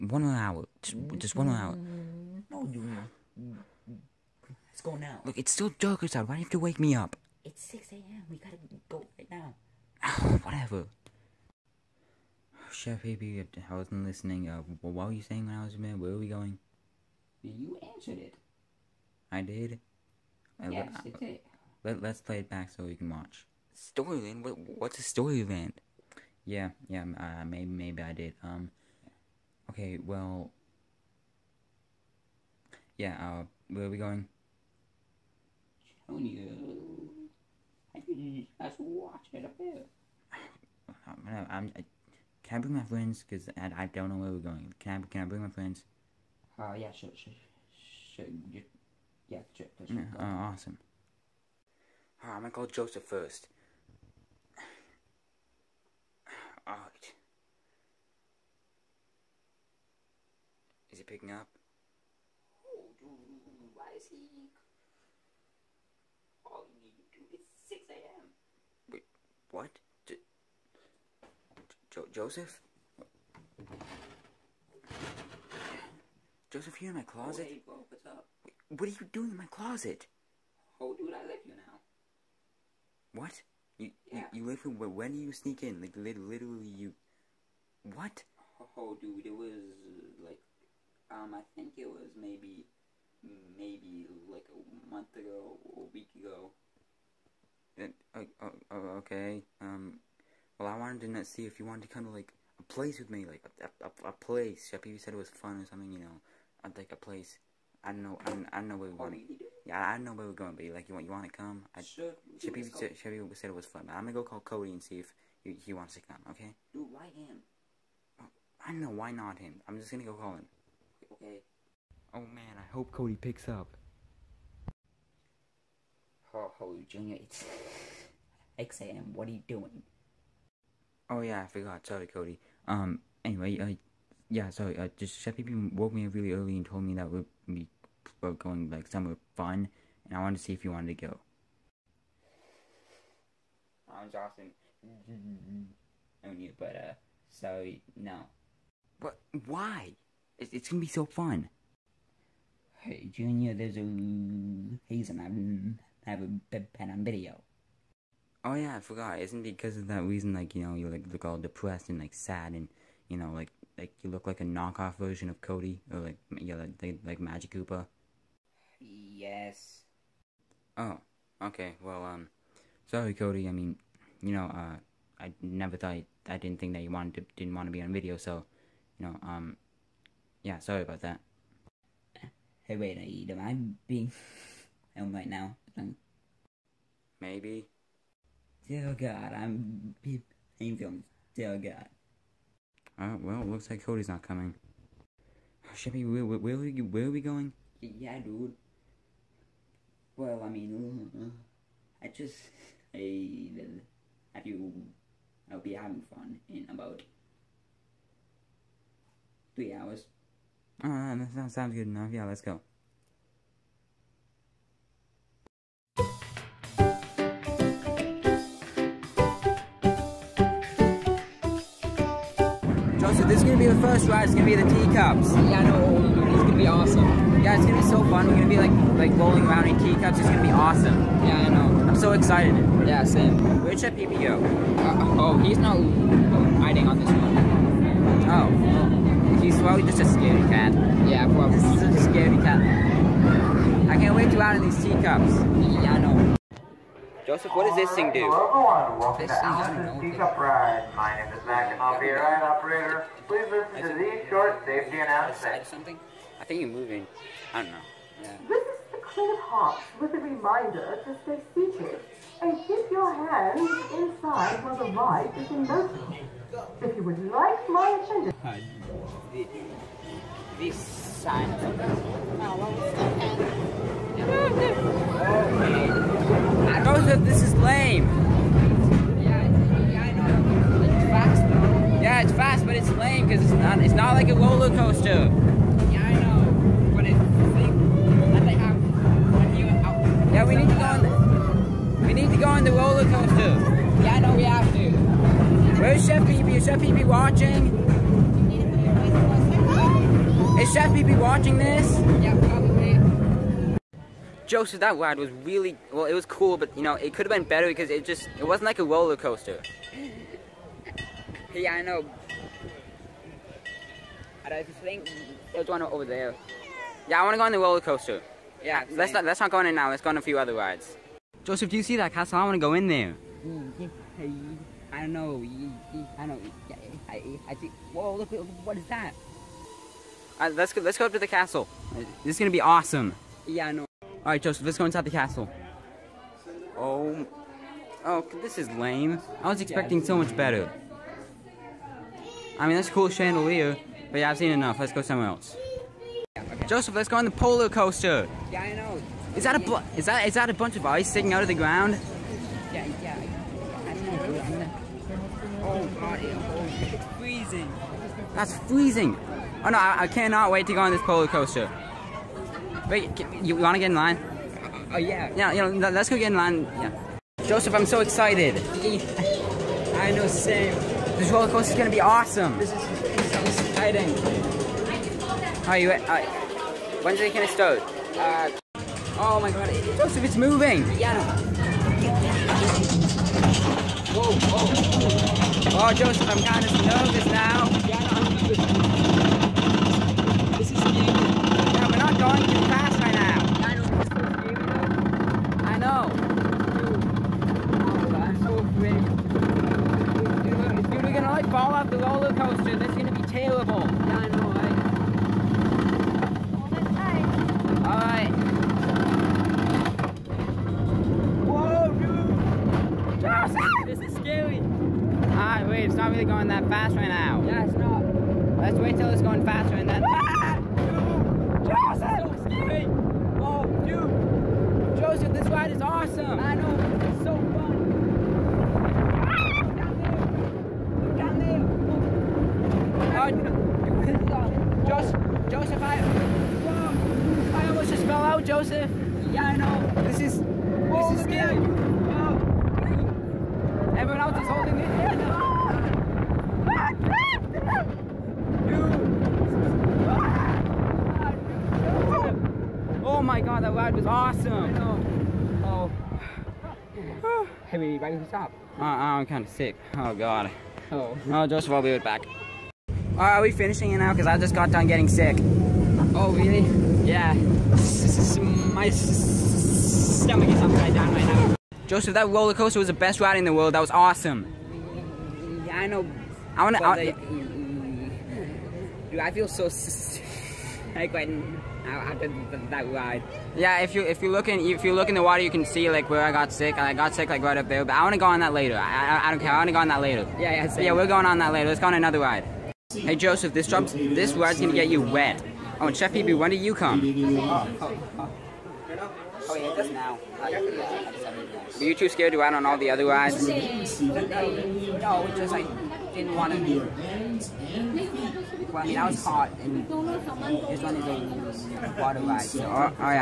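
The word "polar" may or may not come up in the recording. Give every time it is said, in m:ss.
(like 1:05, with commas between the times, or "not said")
5:47, 6:01.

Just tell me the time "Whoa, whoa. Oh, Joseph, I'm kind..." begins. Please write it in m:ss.
6:24.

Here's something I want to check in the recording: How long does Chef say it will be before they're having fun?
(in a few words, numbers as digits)
About three hours.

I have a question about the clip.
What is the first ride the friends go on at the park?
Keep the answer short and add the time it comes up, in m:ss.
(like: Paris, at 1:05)
The teacups, at 3:44.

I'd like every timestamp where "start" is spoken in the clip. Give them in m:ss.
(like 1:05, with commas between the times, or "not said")
6:17.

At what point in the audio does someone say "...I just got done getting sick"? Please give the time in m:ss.
7:44.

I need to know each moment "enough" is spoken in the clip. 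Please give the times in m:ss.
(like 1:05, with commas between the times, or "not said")
3:31, 5:44.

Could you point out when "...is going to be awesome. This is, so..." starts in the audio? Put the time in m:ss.
6:11.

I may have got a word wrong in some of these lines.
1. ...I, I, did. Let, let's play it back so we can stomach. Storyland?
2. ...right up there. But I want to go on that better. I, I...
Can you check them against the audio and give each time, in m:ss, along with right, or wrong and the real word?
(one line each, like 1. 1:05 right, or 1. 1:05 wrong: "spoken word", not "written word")
1. 0:20 wrong: "watch", not "stomach"
2. 8:07 wrong: "later", not "better".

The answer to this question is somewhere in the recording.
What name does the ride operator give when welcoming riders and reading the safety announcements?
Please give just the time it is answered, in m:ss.
4:10.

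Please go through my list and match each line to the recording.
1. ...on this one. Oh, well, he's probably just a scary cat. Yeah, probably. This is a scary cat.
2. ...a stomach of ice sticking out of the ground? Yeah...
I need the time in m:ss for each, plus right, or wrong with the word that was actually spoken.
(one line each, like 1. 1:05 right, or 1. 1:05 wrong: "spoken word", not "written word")
1. 3:56 right
2. 5:50 wrong: "bunch", not "stomach".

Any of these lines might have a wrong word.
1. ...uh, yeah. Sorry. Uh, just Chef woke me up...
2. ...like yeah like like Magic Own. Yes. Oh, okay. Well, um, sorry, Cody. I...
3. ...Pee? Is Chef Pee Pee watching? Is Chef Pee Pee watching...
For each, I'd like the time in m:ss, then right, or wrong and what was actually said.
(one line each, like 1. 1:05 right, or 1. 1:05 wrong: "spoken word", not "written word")
1. 2:13 right
2. 2:45 wrong: "Koopa", not "Own"
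3. 4:56 right.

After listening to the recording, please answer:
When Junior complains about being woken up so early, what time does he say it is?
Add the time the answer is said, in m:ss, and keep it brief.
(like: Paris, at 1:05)
6 a.m., at 0:07.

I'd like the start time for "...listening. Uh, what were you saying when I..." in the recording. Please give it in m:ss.
0:14.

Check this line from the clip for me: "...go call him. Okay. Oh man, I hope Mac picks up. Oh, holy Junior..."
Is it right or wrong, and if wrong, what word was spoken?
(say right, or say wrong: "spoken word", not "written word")
wrong: "Cody", not "Mac".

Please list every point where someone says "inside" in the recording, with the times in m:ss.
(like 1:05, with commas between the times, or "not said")
4:23, 5:34.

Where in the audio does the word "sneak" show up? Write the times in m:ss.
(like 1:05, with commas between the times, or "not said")
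1:25.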